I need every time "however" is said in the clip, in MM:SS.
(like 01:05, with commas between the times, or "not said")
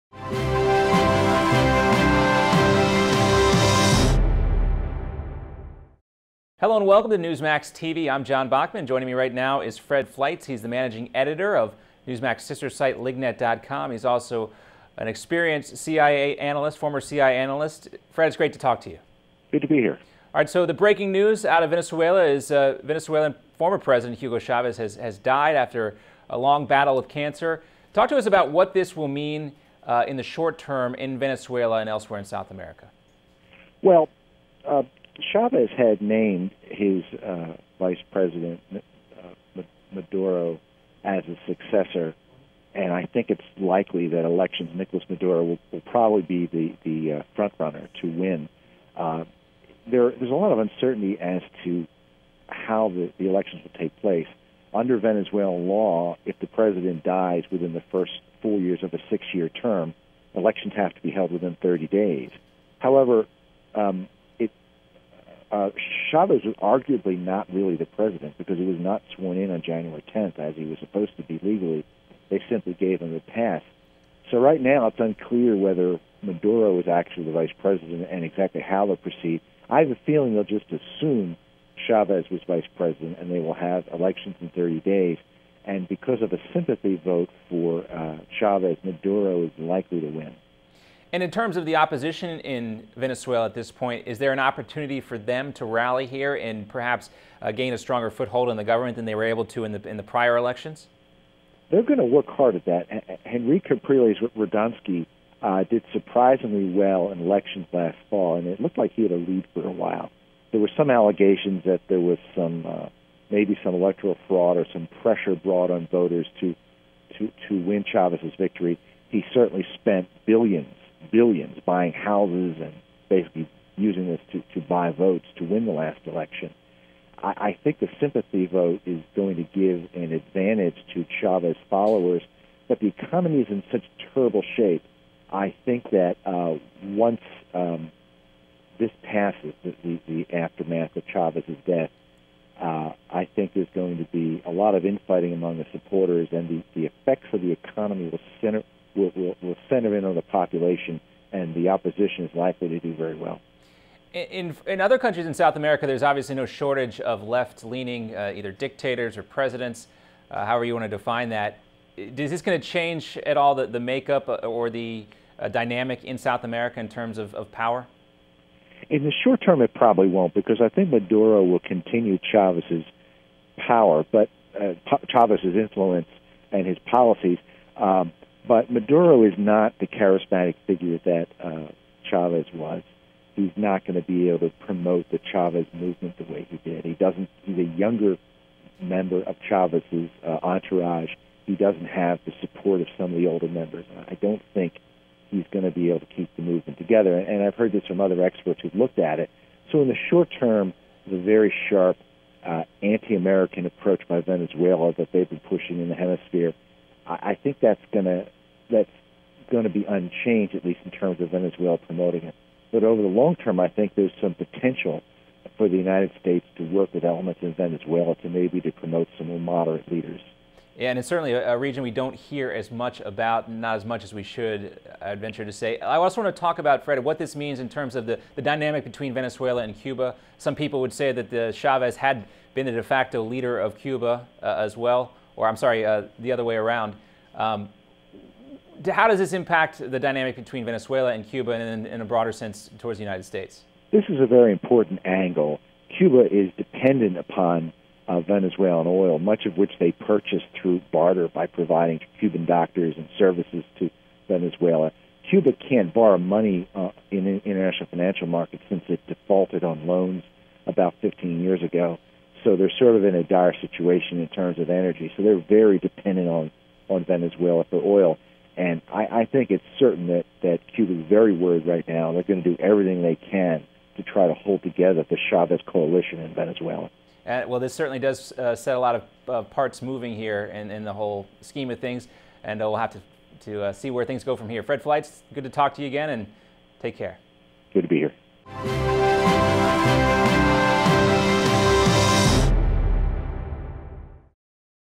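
01:02, 02:40.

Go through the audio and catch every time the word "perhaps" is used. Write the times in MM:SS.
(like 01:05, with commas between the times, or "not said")
01:36.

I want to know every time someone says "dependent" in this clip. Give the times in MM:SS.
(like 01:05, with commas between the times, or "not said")
04:06, 04:25.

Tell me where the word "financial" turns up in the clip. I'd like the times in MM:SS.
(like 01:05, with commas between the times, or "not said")
04:17.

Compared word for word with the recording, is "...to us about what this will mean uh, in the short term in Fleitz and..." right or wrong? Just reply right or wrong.
wrong.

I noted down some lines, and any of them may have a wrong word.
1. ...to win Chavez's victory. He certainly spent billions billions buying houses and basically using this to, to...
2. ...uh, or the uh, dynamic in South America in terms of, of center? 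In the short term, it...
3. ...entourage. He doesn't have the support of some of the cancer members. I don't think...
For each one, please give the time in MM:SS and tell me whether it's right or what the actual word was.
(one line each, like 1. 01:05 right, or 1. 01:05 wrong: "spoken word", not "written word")
1. 01:57 right
2. 02:44 wrong: "power", not "center"
3. 03:10 wrong: "older", not "cancer".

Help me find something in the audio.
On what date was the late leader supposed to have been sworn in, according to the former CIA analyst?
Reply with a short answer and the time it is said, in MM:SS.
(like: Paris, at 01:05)
January 10th, at 01:09.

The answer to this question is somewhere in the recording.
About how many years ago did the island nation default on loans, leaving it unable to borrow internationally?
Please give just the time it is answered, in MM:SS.
04:21.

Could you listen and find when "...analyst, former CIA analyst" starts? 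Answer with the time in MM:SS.
00:16.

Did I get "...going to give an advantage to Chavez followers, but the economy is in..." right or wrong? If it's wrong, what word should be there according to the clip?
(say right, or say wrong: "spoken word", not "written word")
right.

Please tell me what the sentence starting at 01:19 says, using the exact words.
I have a feeling they'll just assume Chavez was vice president and they will have elections in 30 days.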